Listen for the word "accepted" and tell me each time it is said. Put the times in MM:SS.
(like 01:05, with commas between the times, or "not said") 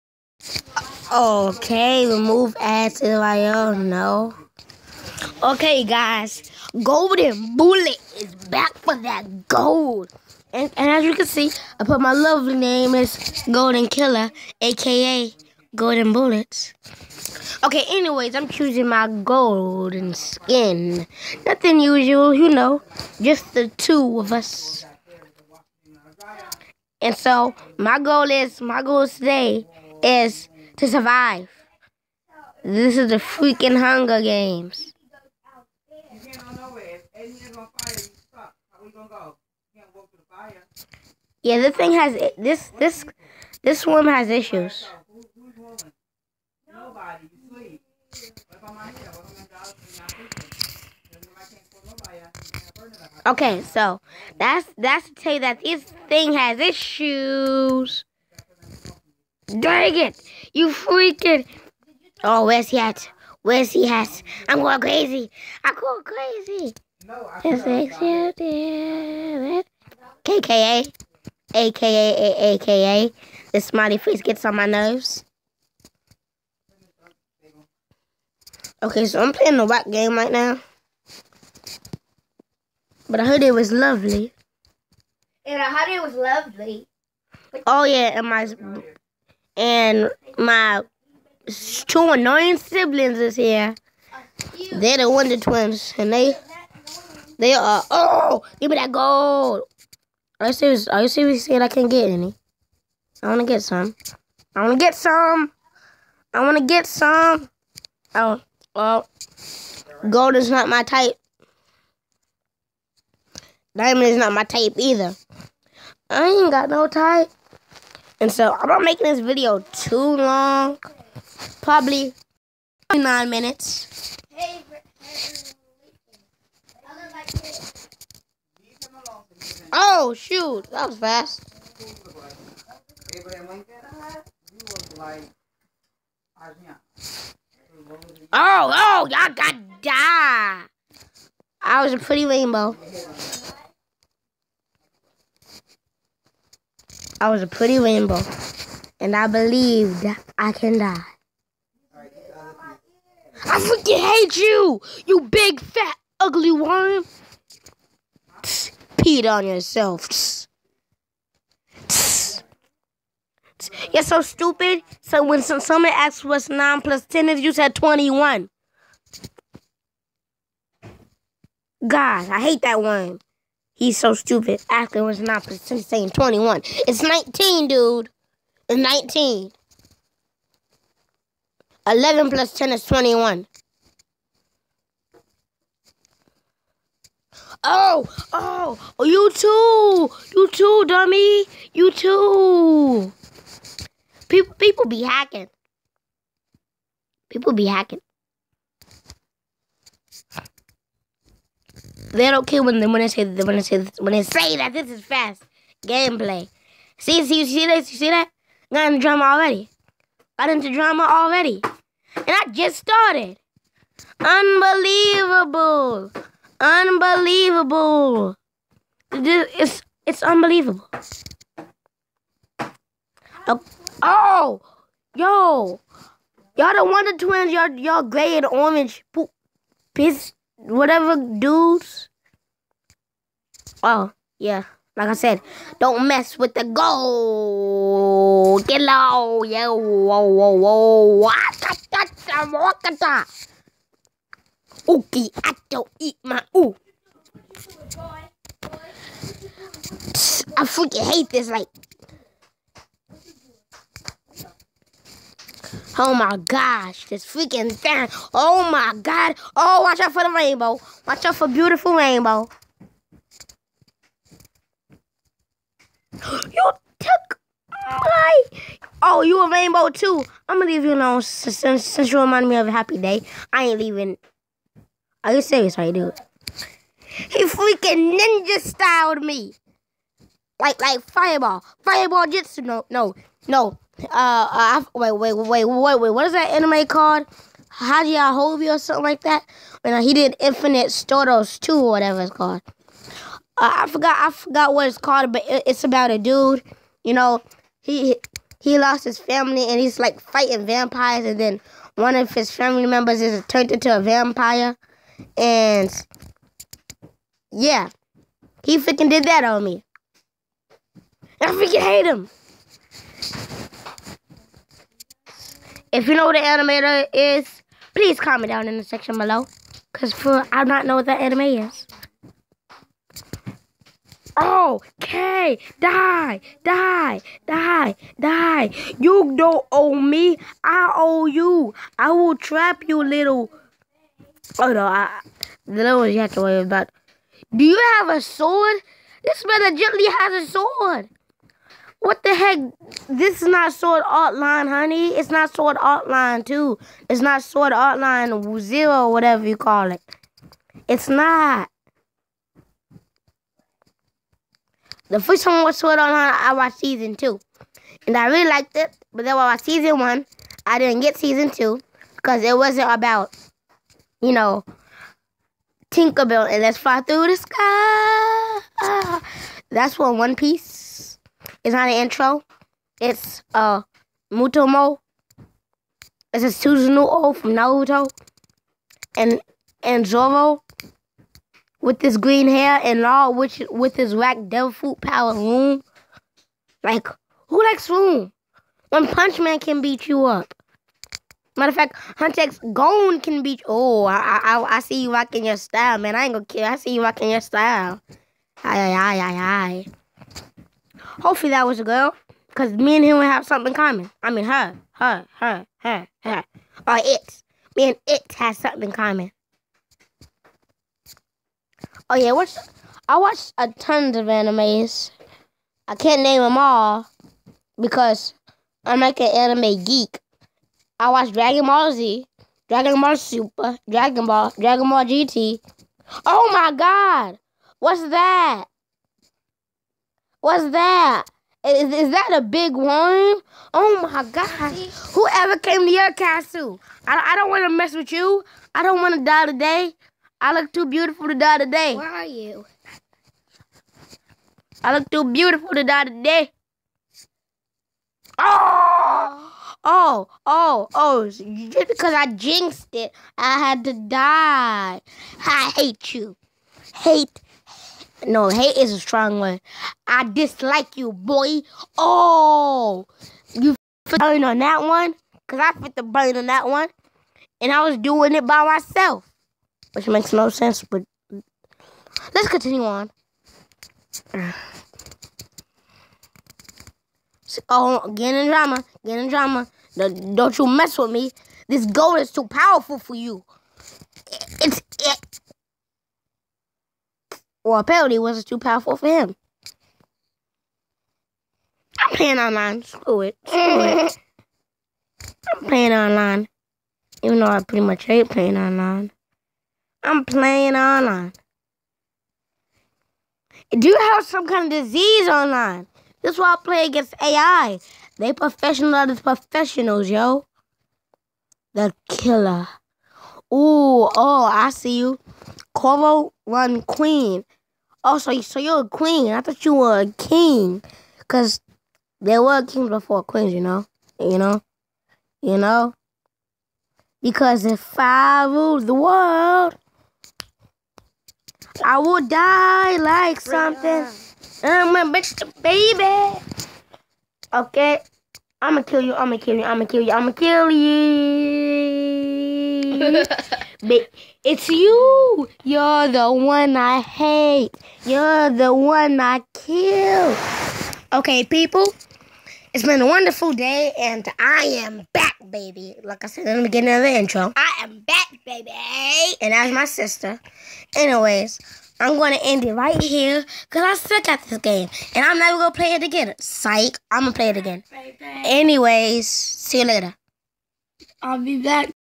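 01:07.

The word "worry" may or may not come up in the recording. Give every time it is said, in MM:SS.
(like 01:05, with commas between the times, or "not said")
05:36.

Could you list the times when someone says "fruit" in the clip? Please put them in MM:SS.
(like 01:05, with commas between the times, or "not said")
06:24.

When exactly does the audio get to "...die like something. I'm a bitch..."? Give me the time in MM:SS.
08:52.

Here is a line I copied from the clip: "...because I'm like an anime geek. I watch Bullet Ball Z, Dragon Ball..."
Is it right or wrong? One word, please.
wrong.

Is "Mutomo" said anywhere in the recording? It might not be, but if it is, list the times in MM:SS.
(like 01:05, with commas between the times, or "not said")
06:14.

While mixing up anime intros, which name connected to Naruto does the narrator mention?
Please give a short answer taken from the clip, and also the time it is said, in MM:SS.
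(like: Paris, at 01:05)
Suzuno, at 06:16.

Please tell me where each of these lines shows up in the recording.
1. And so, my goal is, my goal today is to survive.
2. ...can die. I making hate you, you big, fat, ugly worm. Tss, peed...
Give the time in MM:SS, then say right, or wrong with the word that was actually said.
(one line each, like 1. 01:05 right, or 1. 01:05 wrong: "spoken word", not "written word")
1. 00:27 right
2. 02:30 wrong: "freaking", not "making".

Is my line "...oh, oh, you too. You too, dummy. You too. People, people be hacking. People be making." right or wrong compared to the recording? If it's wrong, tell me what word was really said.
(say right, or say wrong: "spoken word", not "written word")
wrong: "hacking", not "making".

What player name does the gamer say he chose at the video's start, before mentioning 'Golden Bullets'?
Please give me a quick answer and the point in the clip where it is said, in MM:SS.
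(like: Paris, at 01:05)
Golden Killer, at 00:13.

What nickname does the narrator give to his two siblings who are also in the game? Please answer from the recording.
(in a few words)
the Wonder Twins.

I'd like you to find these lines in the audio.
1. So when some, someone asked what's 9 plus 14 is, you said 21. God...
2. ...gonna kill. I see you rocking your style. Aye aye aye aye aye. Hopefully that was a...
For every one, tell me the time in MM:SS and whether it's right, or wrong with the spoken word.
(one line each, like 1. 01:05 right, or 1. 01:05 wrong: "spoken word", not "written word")
1. 02:45 wrong: "10", not "14"
2. 06:36 right.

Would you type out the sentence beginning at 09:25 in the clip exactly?
And I'm never going to play it again.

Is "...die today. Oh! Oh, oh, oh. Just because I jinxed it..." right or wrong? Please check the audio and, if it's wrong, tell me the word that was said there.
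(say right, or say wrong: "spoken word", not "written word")
right.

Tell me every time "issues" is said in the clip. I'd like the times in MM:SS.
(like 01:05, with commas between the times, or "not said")
00:44, 00:56.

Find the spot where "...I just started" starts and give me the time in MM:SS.
03:32.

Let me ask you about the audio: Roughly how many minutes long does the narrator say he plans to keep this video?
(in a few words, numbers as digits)
9.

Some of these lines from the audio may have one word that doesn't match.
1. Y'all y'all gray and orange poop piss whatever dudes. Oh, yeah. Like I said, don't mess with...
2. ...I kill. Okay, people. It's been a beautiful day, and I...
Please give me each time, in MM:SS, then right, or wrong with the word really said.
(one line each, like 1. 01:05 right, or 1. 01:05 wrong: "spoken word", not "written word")
1. 03:47 right
2. 09:09 wrong: "wonderful", not "beautiful".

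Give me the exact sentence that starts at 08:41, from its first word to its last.
Because there were kings before queens, you know?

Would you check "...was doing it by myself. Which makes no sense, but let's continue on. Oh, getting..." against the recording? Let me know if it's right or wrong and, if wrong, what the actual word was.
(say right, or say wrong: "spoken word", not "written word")
right.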